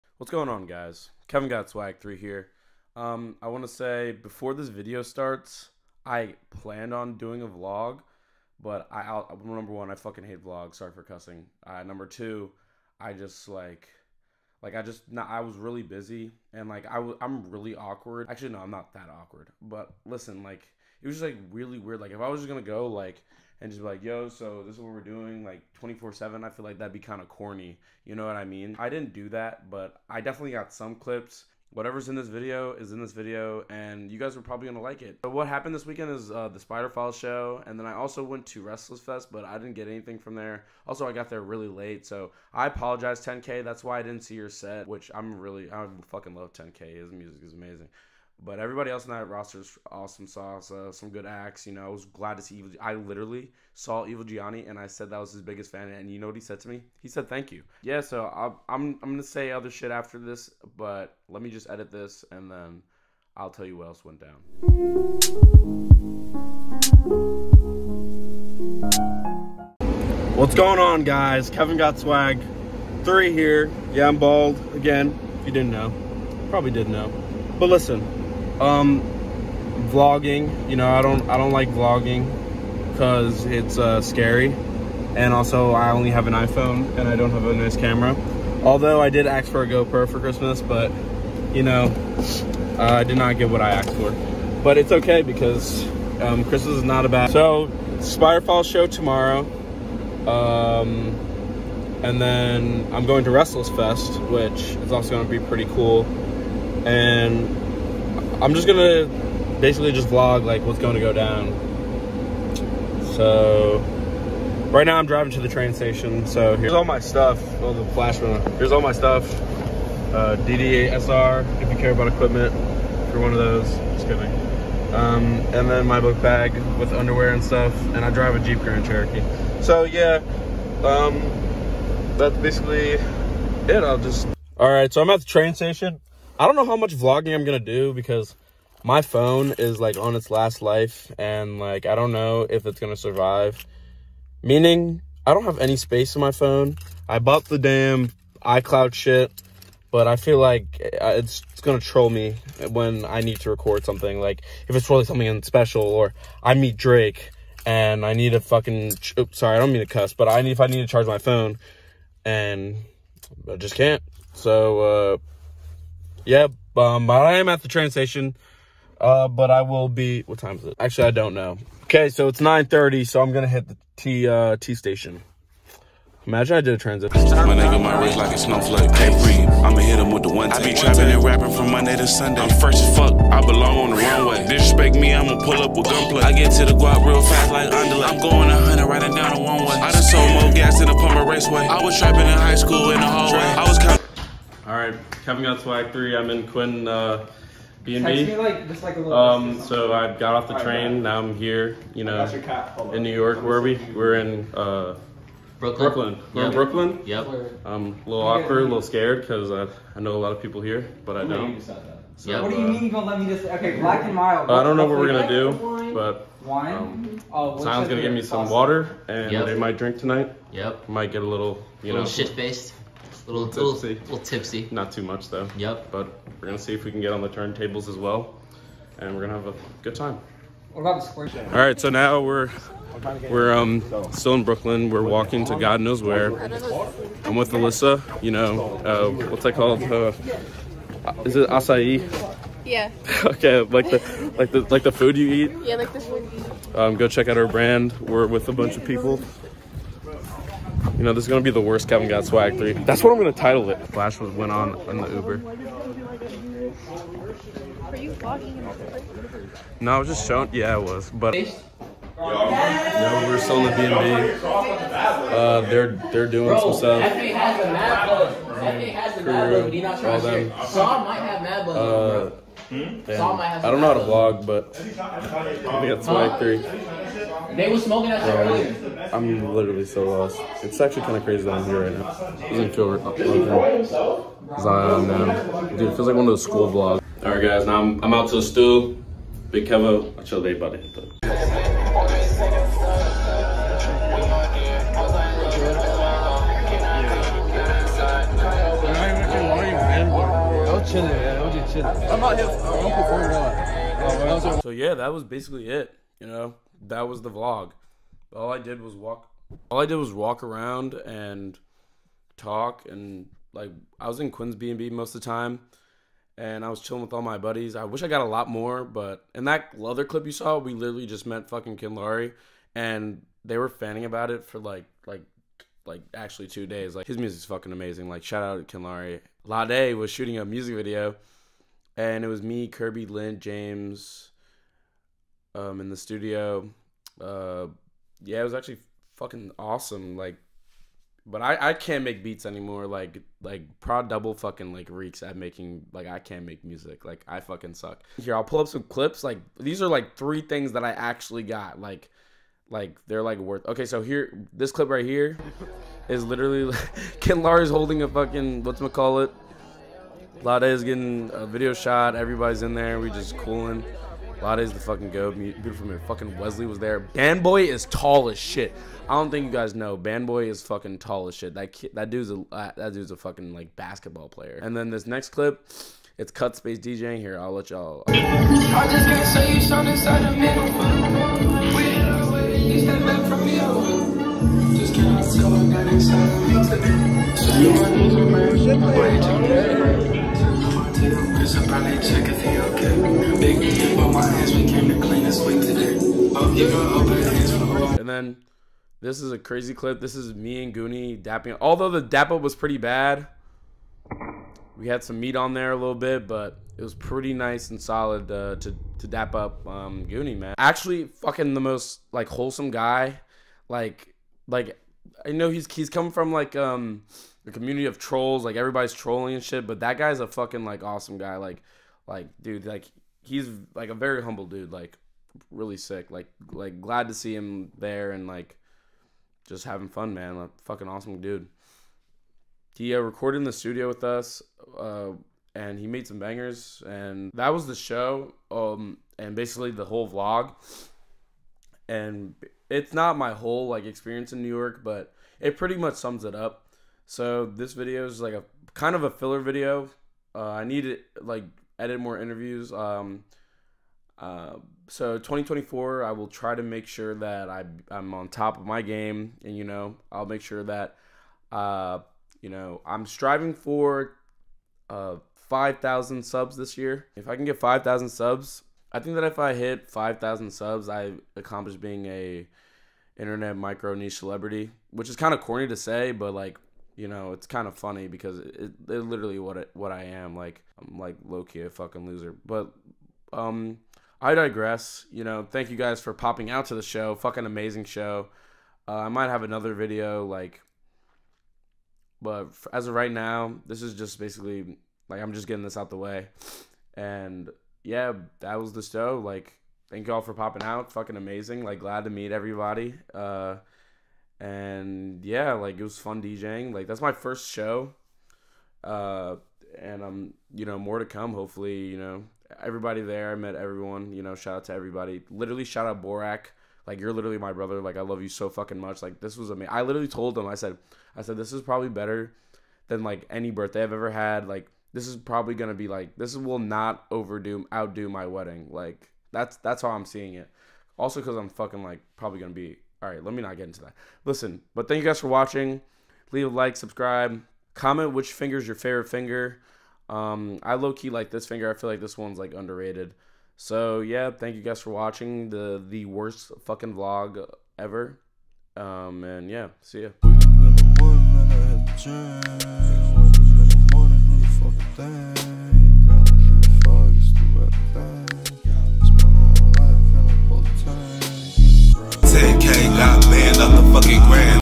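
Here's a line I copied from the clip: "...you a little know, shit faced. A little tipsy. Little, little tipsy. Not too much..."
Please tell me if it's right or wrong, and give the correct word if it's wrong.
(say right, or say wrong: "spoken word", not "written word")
right.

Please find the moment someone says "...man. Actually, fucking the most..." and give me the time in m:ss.
6:50.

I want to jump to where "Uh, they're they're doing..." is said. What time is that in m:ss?
4:24.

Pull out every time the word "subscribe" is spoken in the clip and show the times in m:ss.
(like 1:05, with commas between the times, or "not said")
8:56.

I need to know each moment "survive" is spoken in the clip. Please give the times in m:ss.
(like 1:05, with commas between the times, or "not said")
2:22.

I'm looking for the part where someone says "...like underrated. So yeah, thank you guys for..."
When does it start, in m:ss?
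9:02.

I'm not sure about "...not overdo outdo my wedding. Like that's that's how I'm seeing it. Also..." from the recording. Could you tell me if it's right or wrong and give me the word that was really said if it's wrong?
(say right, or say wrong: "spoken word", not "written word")
right.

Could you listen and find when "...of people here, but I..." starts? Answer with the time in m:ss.
3:30.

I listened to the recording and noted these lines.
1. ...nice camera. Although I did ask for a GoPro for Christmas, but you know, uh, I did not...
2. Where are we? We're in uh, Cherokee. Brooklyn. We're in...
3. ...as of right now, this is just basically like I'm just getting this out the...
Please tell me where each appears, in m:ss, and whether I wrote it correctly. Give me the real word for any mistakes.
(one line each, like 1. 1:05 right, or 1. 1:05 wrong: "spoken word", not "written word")
1. 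1:27 right
2. 3:23 wrong: "Brooklyn", not "Cherokee"
3. 8:12 right.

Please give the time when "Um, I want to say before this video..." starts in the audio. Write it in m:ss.
0:02.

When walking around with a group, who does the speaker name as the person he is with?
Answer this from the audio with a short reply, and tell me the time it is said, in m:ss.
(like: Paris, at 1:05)
Alyssa, at 3:57.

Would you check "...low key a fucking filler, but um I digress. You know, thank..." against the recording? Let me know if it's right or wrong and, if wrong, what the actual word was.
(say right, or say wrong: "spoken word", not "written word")
wrong: "loser", not "filler".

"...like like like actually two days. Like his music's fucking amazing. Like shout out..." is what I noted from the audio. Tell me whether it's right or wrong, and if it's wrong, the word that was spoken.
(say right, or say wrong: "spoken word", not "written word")
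right.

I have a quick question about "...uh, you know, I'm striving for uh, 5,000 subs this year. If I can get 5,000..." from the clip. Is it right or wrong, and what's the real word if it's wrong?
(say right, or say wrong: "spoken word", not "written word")
right.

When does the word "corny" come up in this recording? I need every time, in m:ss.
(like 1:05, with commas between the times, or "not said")
0:27, 7:55.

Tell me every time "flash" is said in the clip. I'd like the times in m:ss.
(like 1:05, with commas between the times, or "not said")
1:57, 4:13.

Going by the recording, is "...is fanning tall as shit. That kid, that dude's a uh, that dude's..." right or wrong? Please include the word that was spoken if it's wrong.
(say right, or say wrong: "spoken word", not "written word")
wrong: "fucking", not "fanning".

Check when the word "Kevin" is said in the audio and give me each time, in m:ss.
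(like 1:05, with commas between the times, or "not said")
0:01, 1:11, 3:15, 4:11.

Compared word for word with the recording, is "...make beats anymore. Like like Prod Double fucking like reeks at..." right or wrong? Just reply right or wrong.
right.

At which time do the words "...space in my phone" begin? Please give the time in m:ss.
2:25.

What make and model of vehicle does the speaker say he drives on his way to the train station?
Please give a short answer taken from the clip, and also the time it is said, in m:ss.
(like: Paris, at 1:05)
Jeep Grand Cherokee, at 2:08.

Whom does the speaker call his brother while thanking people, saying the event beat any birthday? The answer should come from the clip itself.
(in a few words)
Borak.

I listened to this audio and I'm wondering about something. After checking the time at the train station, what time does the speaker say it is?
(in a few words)
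9:30.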